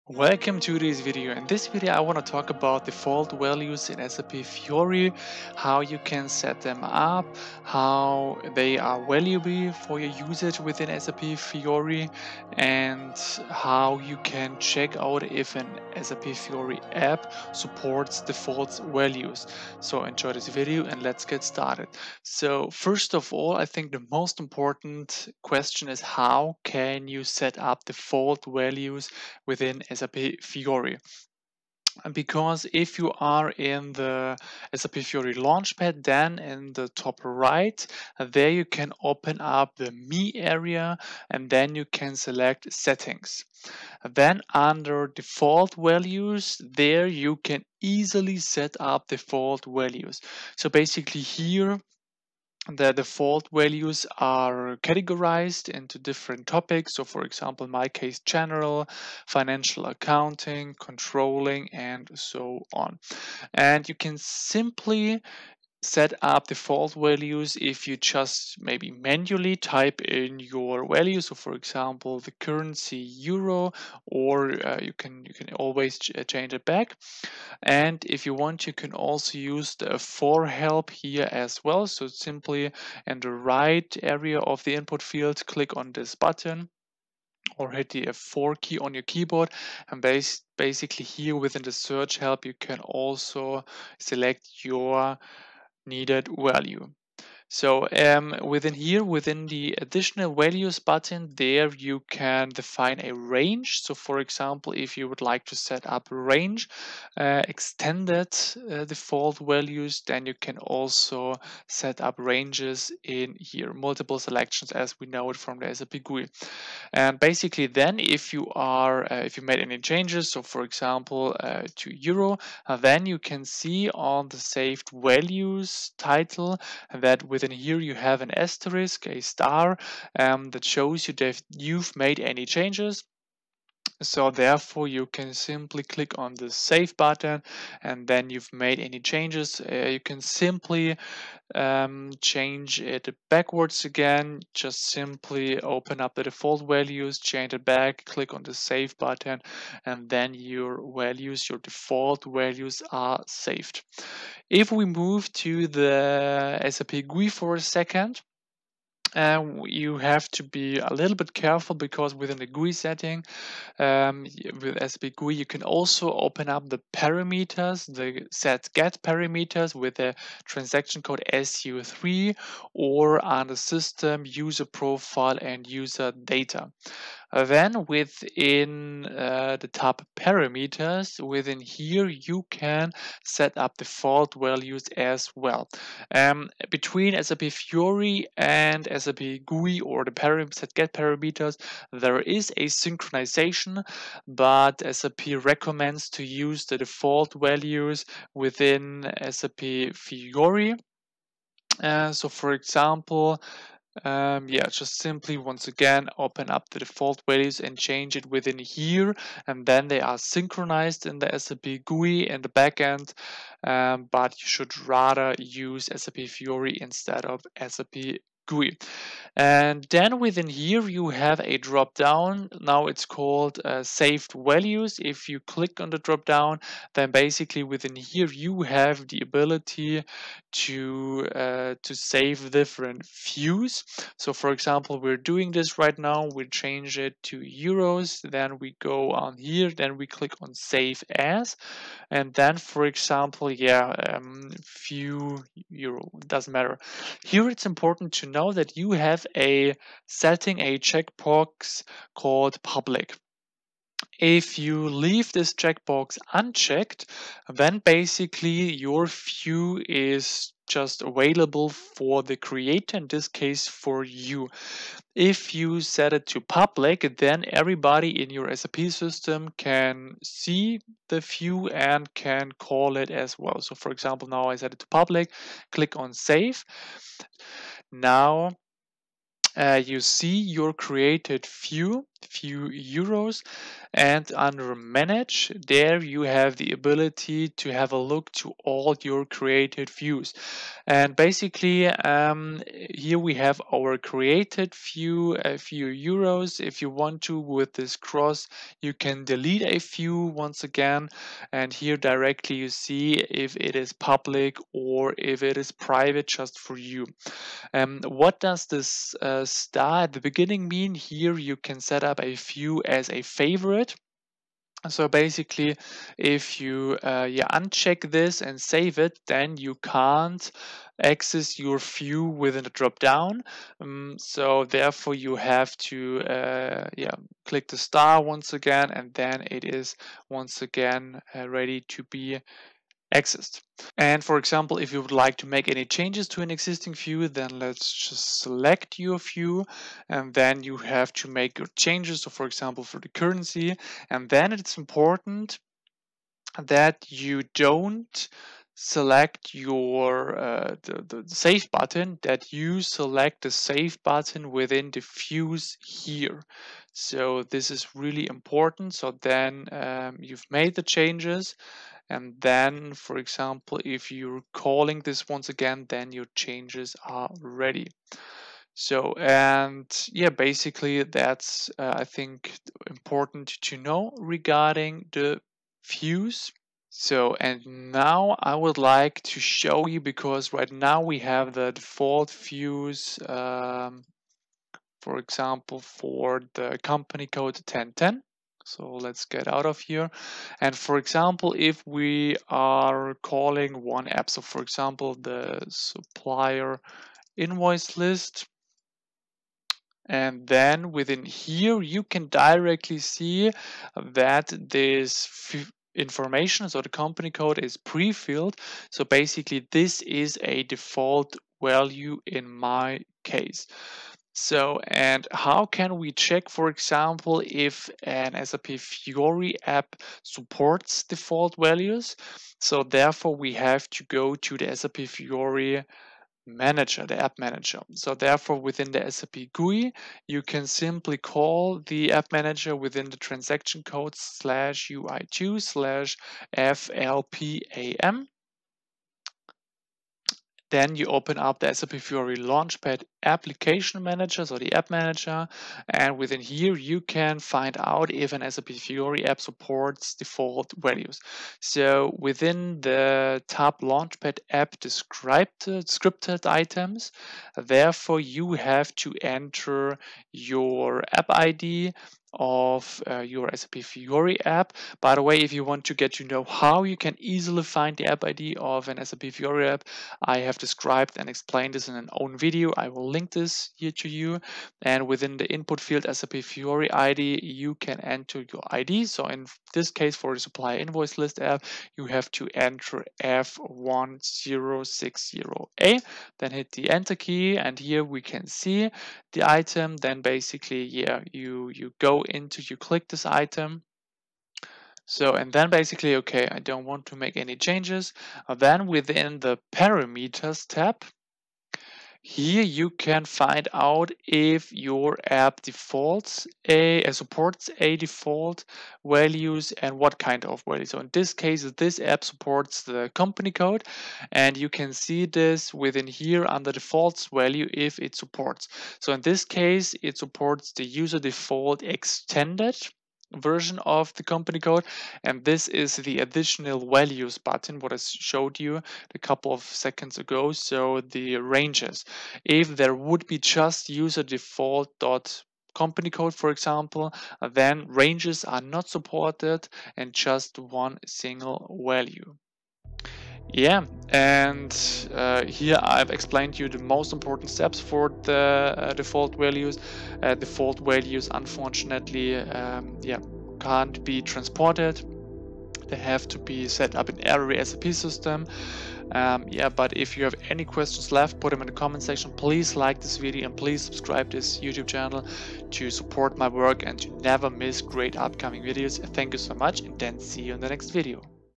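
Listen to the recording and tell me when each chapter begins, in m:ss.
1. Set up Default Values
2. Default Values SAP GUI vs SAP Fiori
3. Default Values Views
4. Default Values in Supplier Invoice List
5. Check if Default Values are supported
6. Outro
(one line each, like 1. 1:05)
1. 0:22
2. 2:34
3. 3:39
4. 6:16
5. 6:54
6. 9:02.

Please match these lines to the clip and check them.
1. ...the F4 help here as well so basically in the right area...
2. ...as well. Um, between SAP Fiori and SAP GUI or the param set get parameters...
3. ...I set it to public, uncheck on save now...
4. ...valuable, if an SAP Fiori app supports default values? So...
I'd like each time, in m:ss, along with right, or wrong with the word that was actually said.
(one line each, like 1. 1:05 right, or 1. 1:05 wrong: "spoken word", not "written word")
1. 1:19 wrong: "simply", not "basically"
2. 3:04 right
3. 4:34 wrong: "click", not "uncheck"
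4. 6:56 wrong: "example", not "valuable".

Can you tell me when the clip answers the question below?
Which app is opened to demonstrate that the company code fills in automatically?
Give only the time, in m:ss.
6:35.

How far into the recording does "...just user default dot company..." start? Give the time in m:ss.
8:53.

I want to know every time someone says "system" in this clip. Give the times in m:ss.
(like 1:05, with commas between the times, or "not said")
2:53, 4:28, 9:17.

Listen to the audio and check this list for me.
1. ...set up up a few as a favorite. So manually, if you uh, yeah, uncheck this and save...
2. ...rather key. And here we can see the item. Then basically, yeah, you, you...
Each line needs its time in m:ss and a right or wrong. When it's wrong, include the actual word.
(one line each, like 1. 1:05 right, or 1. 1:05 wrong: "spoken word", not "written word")
1. 5:11 wrong: "basically", not "manually"
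2. 8:06 wrong: "enter", not "rather".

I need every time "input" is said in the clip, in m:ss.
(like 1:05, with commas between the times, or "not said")
1:24, 7:55.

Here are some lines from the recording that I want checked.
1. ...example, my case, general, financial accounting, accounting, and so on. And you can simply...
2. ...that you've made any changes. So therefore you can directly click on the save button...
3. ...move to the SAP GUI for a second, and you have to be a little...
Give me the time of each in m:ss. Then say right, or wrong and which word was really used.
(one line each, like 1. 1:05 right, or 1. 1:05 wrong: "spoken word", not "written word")
1. 0:57 wrong: "controlling", not "accounting"
2. 2:11 wrong: "simply", not "directly"
3. 2:34 right.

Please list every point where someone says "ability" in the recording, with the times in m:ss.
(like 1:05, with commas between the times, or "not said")
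3:49, 4:46.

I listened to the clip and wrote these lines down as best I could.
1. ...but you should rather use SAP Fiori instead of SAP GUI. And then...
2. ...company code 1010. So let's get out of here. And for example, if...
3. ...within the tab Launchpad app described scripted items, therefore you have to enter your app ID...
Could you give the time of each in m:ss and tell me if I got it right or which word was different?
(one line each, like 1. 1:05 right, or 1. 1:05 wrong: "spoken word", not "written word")
1. 3:34 right
2. 6:26 right
3. 7:32 right.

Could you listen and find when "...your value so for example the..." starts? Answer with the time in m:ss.
1:10.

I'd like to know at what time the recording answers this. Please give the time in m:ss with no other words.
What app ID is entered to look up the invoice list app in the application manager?
8:03.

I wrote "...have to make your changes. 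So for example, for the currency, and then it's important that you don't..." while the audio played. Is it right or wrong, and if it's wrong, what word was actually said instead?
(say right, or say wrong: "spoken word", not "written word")
right.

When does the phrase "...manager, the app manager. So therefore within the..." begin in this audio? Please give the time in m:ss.
7:06.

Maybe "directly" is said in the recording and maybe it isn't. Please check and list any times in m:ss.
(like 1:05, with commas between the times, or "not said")
5:01, 6:42.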